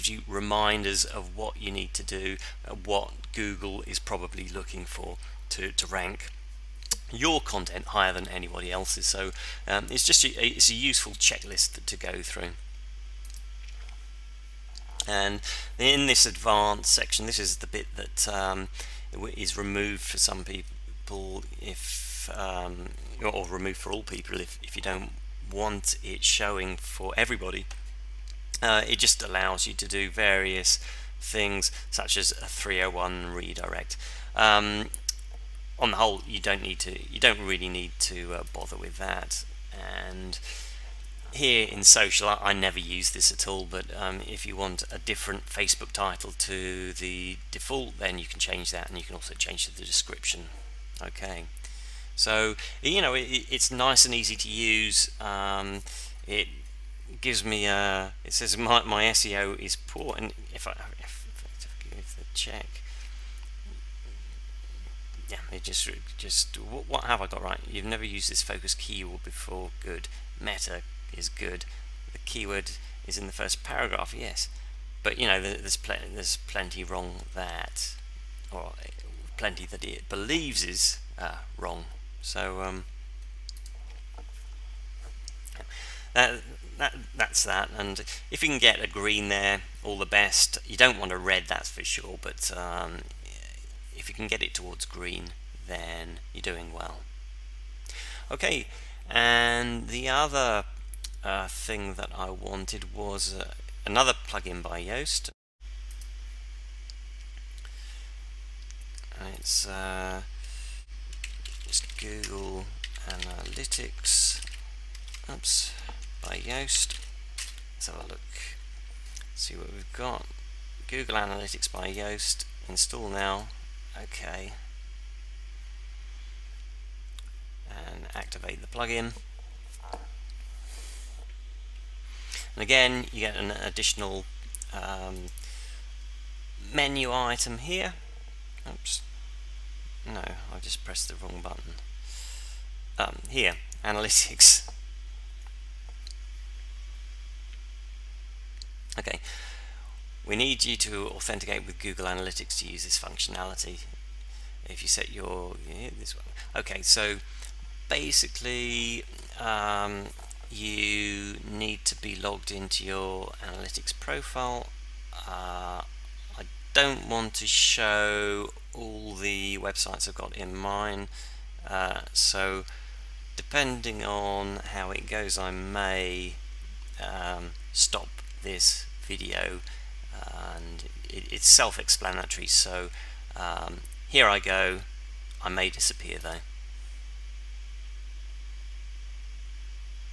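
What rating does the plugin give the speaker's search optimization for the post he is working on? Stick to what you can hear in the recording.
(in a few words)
poor.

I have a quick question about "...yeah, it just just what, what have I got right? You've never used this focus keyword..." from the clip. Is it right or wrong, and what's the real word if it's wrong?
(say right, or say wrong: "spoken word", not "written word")
right.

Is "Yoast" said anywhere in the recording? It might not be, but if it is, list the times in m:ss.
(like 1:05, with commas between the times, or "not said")
1:44, 1:56, 2:01.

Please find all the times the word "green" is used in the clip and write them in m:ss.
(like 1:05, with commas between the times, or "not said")
1:28, 1:34.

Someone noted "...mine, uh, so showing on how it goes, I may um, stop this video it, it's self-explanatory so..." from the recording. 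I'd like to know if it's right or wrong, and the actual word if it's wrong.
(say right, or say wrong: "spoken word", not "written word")
wrong: "depending", not "showing".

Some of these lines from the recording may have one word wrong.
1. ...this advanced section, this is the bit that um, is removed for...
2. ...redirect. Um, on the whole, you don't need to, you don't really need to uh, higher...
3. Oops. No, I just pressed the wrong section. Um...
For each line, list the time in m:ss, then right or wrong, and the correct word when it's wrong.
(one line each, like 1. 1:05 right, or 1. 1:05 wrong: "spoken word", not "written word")
1. 0:16 right
2. 0:33 wrong: "bother", not "higher"
3. 2:18 wrong: "button", not "section".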